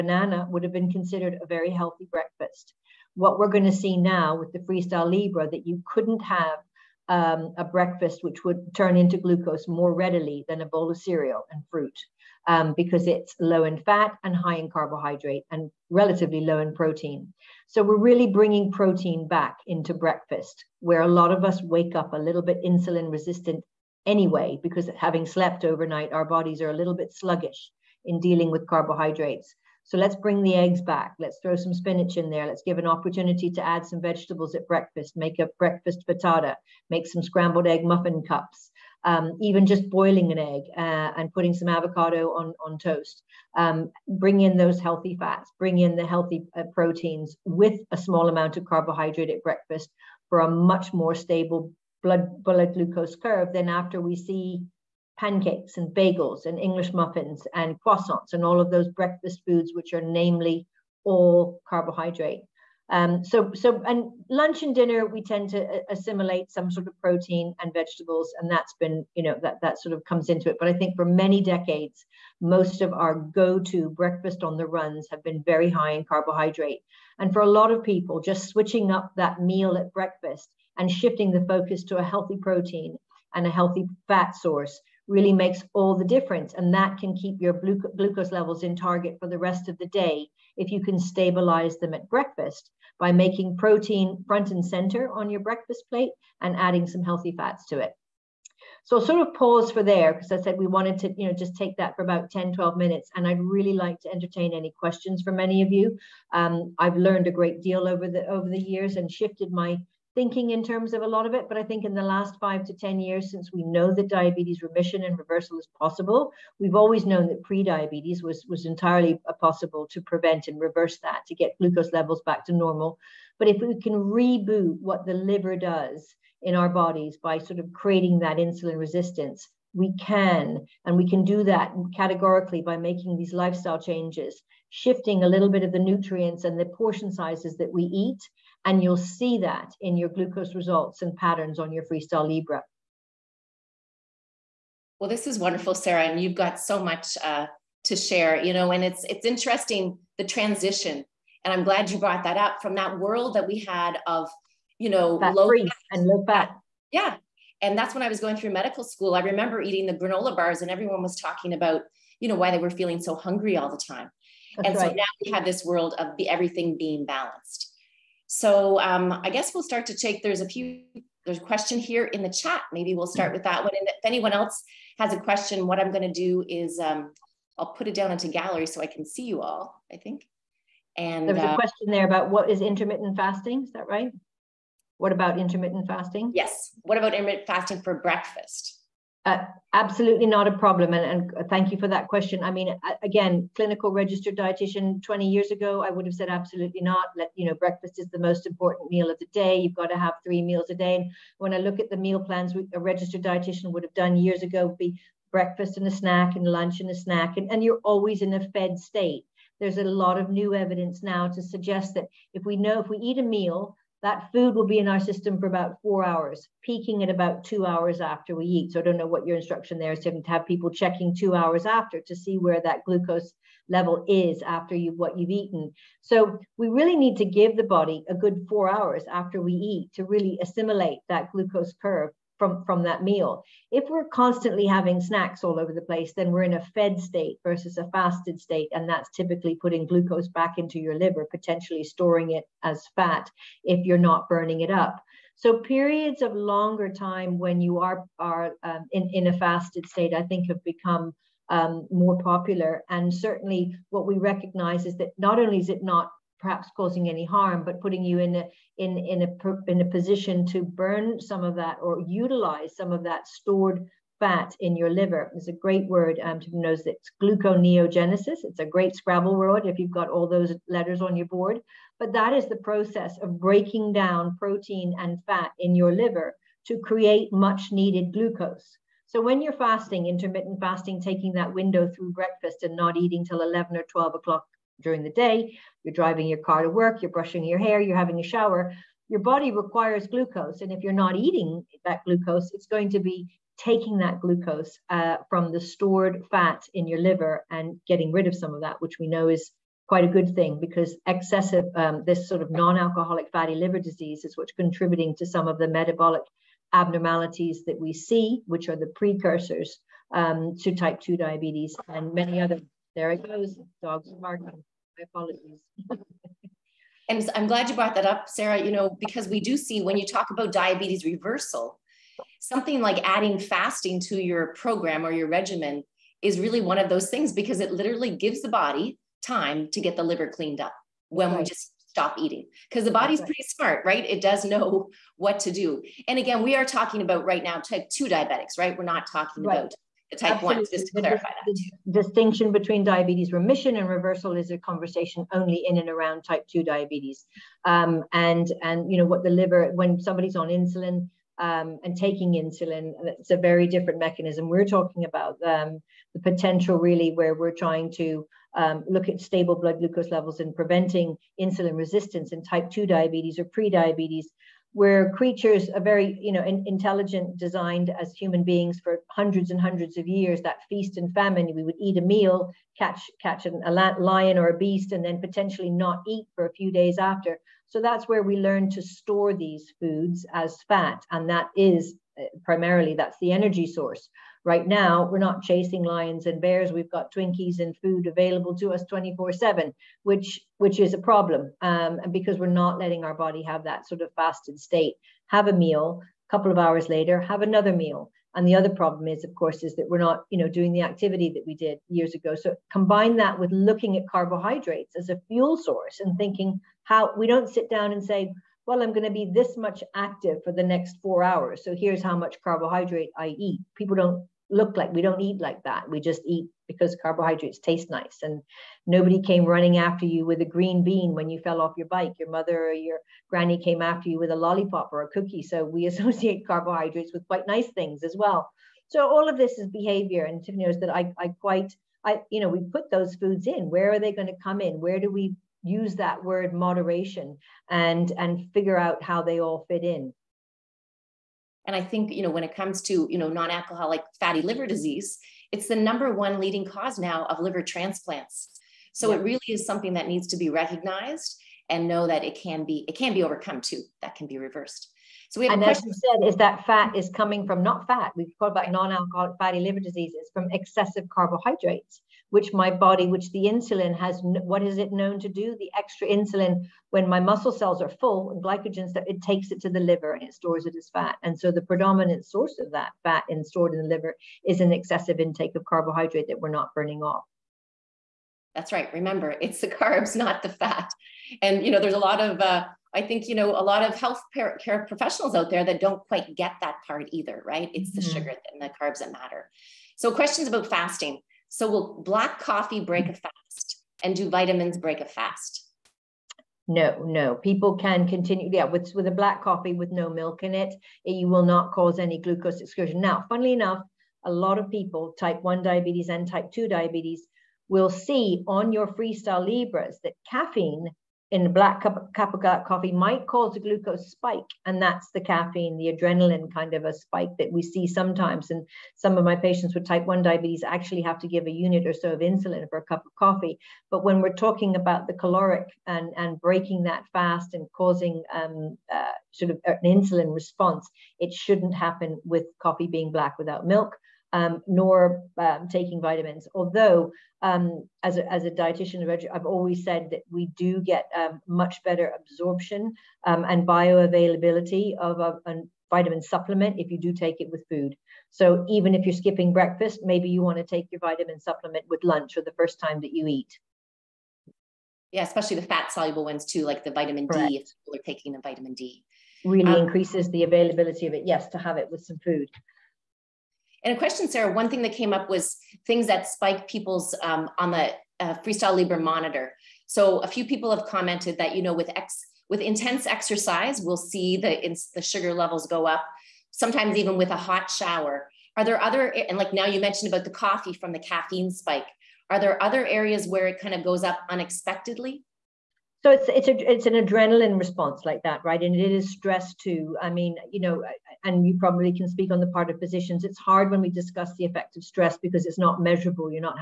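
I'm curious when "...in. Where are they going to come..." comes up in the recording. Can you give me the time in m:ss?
7:13.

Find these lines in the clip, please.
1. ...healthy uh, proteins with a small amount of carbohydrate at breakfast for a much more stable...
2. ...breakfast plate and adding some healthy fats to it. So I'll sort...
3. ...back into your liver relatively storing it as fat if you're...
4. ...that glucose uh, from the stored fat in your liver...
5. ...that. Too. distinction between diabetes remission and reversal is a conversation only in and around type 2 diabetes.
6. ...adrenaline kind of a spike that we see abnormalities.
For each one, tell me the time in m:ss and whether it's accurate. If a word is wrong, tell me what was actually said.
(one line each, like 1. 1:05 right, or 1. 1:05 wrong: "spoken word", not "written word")
1. 0:46 right
2. 1:35 right
3. 4:00 wrong: "potentially", not "relatively"
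4. 4:53 right
5. 5:41 right
6. 8:35 wrong: "sometimes", not "abnormalities".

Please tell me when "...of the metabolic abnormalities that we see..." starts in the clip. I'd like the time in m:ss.
5:05.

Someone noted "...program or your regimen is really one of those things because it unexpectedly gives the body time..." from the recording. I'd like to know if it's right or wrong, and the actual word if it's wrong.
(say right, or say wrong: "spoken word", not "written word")
wrong: "literally", not "unexpectedly".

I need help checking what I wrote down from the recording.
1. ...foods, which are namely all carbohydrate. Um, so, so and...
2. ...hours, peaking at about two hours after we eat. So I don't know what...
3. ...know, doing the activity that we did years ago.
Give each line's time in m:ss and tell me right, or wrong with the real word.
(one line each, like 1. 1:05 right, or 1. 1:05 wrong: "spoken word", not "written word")
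1. 0:59 right
2. 3:36 right
3. 6:40 right.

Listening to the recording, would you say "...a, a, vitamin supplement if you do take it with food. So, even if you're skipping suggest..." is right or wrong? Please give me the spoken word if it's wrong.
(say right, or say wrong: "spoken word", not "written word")
wrong: "breakfast", not "suggest".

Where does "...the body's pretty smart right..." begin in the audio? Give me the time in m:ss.
5:32.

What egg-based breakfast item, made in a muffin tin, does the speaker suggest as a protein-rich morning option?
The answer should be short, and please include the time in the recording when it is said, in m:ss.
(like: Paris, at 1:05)
scrambled egg muffin cups, at 0:37.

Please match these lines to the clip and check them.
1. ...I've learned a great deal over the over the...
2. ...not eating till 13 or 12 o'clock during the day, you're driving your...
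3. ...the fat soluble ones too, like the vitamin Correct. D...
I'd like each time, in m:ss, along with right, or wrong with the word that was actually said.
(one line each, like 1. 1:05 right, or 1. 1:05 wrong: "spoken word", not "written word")
1. 1:46 right
2. 4:42 wrong: "11", not "13"
3. 9:15 right.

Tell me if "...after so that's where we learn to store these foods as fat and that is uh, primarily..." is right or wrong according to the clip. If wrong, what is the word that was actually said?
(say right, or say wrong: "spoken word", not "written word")
right.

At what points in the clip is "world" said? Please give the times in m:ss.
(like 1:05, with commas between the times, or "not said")
2:32, 2:45.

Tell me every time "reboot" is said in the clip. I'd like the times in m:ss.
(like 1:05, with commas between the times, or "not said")
2:03.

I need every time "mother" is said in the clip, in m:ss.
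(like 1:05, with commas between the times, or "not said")
7:02.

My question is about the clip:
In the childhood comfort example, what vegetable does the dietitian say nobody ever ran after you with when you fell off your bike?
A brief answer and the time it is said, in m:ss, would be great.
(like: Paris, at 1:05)
green bean, at 7:00.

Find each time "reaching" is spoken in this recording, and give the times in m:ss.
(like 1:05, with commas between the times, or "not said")
not said.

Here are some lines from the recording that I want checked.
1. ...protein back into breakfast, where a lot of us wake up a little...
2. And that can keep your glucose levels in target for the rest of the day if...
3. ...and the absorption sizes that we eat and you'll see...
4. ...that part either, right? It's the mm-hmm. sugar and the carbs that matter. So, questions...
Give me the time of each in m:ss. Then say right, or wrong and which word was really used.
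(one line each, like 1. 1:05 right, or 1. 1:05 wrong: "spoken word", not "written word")
1. 0:18 right
2. 1:26 right
3. 2:16 wrong: "portion", not "absorption"
4. 8:06 right.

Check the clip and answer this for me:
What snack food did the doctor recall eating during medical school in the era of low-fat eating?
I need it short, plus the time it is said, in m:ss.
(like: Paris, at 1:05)
granola bars, at 2:39.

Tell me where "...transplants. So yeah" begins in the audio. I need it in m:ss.
7:27.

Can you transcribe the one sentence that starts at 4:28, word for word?
It's a great Scrabble word if you've got all those letters on your board.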